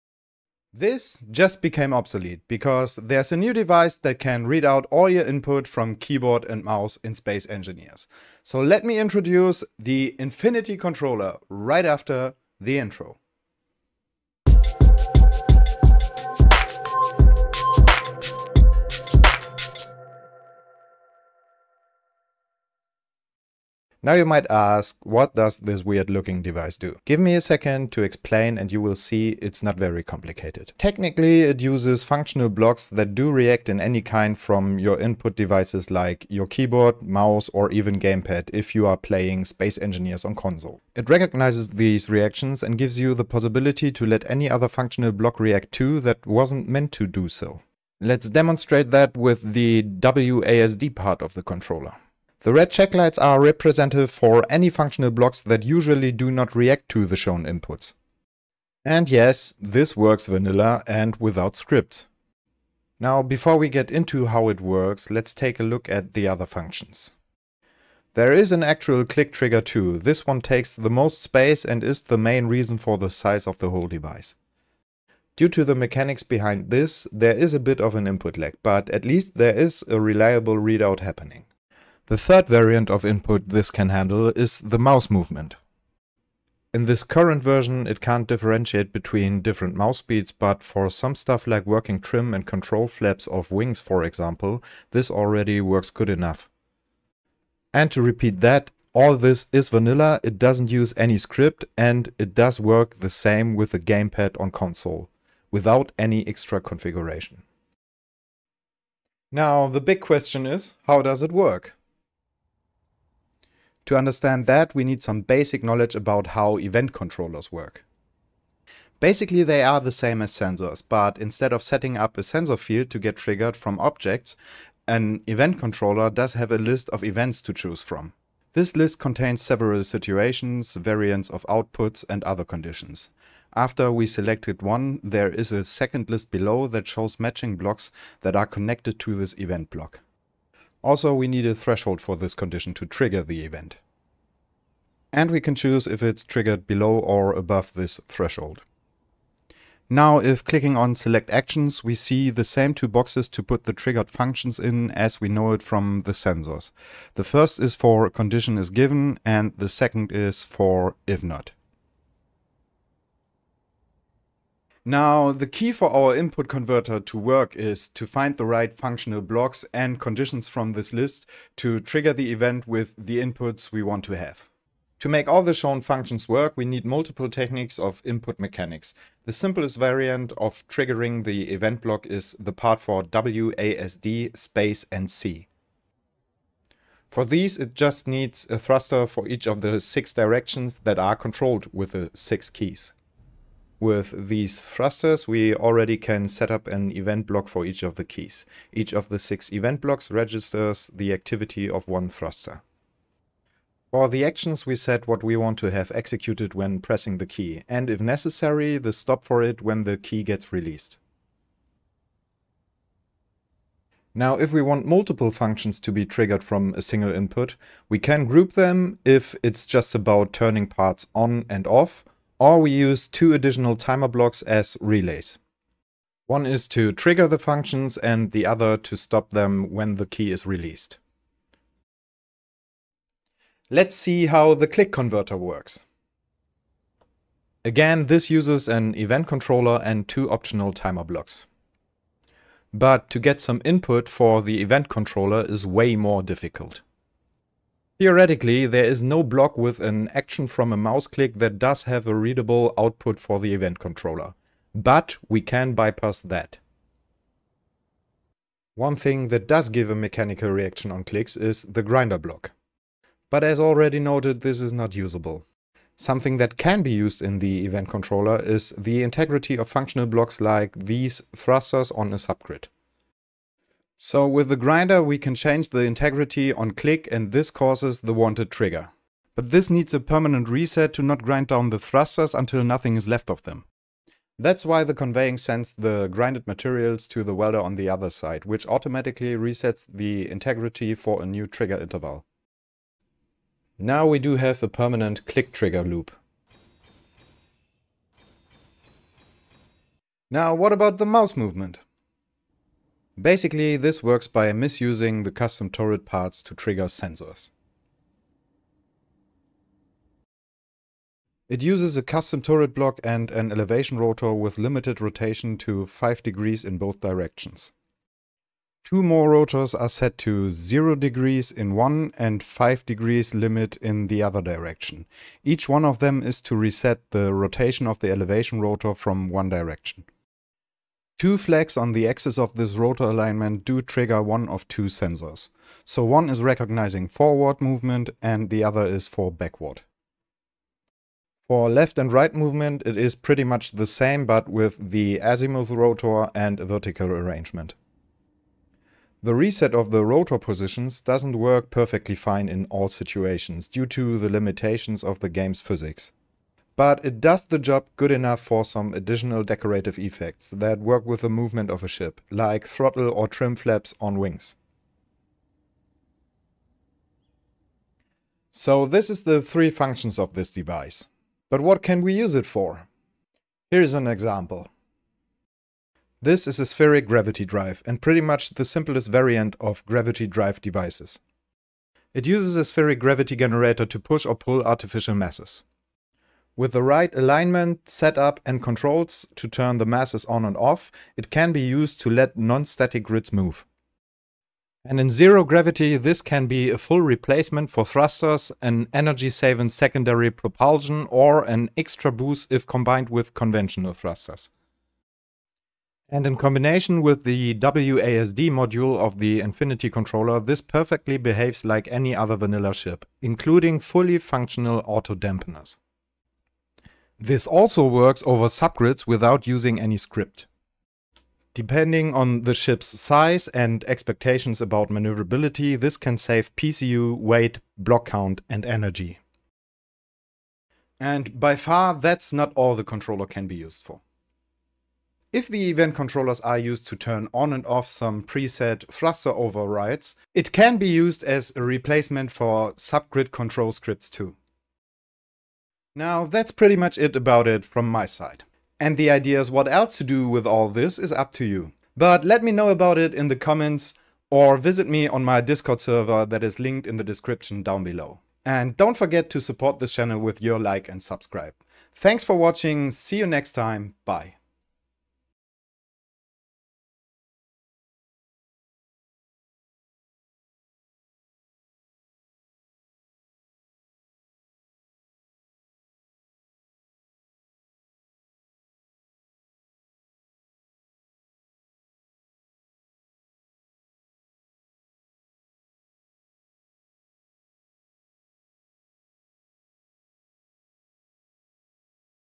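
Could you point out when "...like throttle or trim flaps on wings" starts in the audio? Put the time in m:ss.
6:02.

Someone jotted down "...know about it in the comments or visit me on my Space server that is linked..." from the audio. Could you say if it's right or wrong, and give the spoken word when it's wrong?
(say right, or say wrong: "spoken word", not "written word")
wrong: "Discord", not "Space".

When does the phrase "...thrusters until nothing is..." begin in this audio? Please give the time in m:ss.
4:41.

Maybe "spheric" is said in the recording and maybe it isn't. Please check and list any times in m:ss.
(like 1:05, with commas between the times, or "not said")
6:16, 6:22.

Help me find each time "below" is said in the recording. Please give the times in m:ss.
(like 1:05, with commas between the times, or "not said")
2:16, 2:26, 7:37.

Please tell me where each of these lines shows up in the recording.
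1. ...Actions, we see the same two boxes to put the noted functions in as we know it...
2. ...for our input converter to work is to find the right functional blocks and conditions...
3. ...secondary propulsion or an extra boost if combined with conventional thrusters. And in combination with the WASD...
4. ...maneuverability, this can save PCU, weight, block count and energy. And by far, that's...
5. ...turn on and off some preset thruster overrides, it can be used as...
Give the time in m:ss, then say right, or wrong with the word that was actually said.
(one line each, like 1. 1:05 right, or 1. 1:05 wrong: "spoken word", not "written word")
1. 2:31 wrong: "triggered", not "noted"
2. 2:45 right
3. 6:39 right
4. 7:04 right
5. 7:16 right.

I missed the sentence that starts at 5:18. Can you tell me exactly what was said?
Two more rotors are set to 0 degrees in one and 5 degrees limit in the other direction.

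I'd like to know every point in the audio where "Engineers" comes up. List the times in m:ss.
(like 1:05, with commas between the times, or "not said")
0:07, 0:39.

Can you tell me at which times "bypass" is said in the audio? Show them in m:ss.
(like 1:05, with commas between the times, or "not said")
4:15.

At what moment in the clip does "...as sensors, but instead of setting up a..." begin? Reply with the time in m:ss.
2:00.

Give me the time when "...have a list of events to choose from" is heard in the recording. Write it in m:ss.
2:06.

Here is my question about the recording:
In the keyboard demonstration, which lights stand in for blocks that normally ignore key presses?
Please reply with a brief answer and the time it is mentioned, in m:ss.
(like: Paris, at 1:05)
Red checklights, at 0:52.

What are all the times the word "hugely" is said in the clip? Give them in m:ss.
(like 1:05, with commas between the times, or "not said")
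not said.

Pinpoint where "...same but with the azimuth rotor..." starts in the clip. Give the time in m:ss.
5:43.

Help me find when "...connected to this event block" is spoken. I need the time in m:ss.
2:18.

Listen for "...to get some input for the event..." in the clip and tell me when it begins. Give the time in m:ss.
4:03.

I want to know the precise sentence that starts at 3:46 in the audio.
One is to trigger the functions and the other to stop them when the key is released.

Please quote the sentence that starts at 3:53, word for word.
Let's see how the click converter works.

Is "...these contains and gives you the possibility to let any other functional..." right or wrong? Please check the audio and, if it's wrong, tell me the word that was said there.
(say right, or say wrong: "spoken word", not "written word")
wrong: "reactions", not "contains".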